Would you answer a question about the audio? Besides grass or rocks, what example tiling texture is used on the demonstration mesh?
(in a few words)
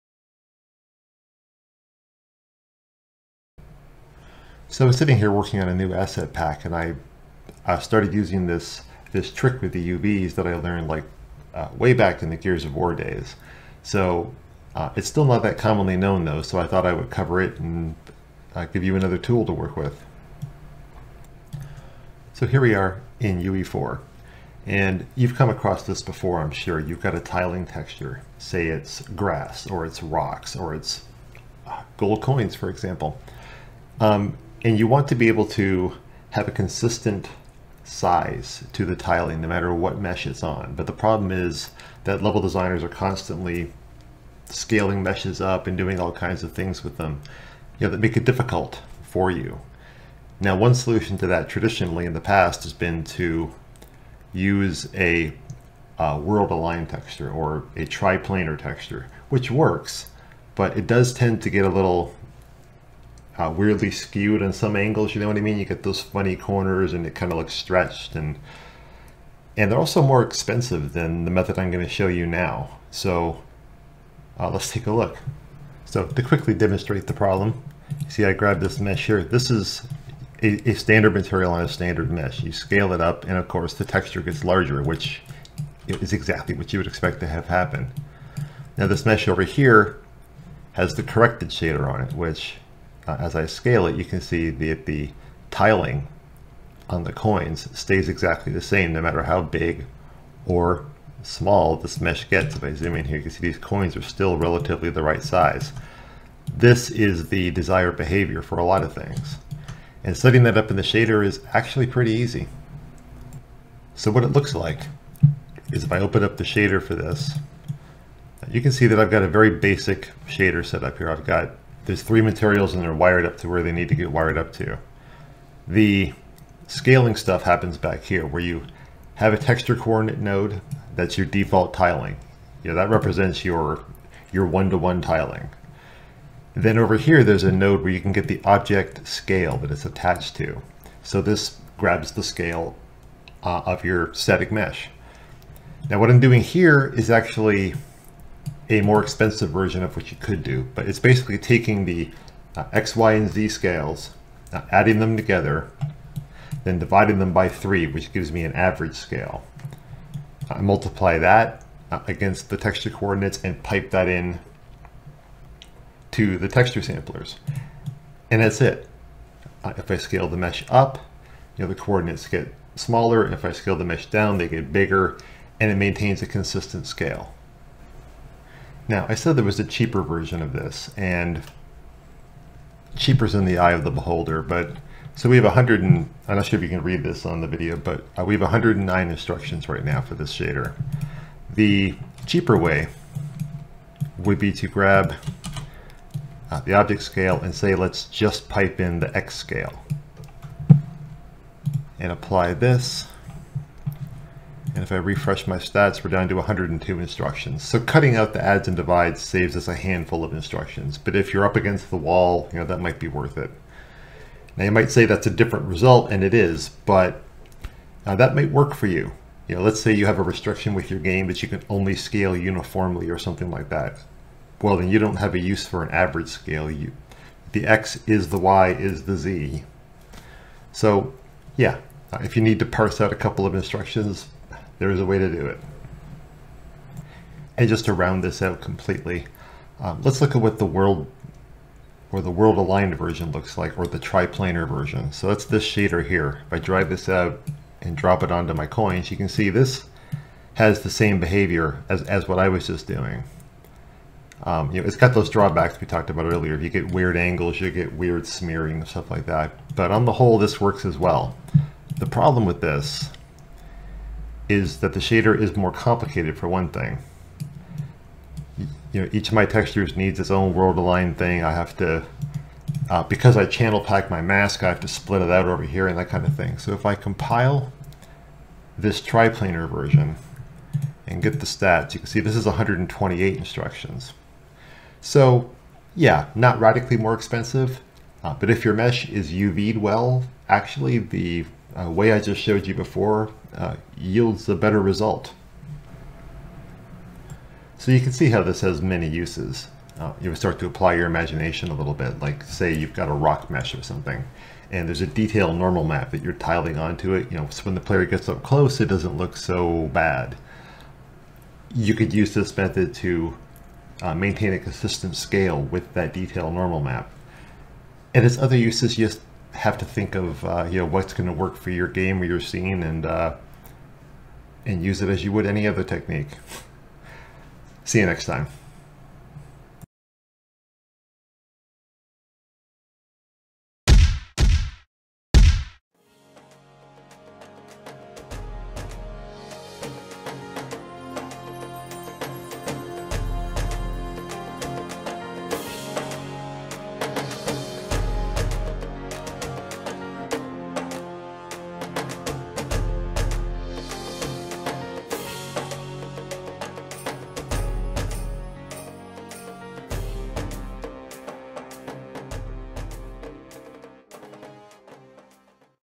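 gold coins.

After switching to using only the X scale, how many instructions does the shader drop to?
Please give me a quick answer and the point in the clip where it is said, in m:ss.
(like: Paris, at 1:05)
102, at 3:26.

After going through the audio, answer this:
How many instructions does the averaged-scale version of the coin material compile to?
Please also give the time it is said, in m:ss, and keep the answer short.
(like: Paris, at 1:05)
109, at 3:08.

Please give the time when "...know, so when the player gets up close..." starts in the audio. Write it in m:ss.
5:07.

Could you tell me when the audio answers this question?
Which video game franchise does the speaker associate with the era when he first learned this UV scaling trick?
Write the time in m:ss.
0:12.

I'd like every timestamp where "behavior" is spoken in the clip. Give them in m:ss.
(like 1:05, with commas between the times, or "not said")
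1:47, 4:11.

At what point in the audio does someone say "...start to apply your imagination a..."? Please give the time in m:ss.
5:00.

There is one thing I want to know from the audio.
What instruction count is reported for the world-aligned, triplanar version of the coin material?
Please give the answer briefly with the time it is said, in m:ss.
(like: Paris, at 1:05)
128, at 4:42.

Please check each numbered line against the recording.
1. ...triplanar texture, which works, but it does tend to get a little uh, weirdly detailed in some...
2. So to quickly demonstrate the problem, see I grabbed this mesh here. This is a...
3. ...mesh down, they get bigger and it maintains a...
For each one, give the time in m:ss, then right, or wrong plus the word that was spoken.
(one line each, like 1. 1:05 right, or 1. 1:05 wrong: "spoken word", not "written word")
1. 0:57 wrong: "skewed", not "detailed"
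2. 1:15 right
3. 2:53 right.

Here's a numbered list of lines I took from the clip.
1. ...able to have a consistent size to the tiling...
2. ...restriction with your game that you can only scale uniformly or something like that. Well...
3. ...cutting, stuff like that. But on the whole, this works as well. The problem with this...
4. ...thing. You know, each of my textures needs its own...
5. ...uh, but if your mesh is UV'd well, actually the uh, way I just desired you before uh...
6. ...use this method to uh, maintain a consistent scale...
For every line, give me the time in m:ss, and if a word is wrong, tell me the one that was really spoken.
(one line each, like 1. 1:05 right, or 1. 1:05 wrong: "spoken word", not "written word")
1. 0:35 right
2. 3:40 right
3. 4:18 wrong: "smearing", not "cutting"
4. 4:26 right
5. 4:48 wrong: "showed", not "desired"
6. 5:12 right.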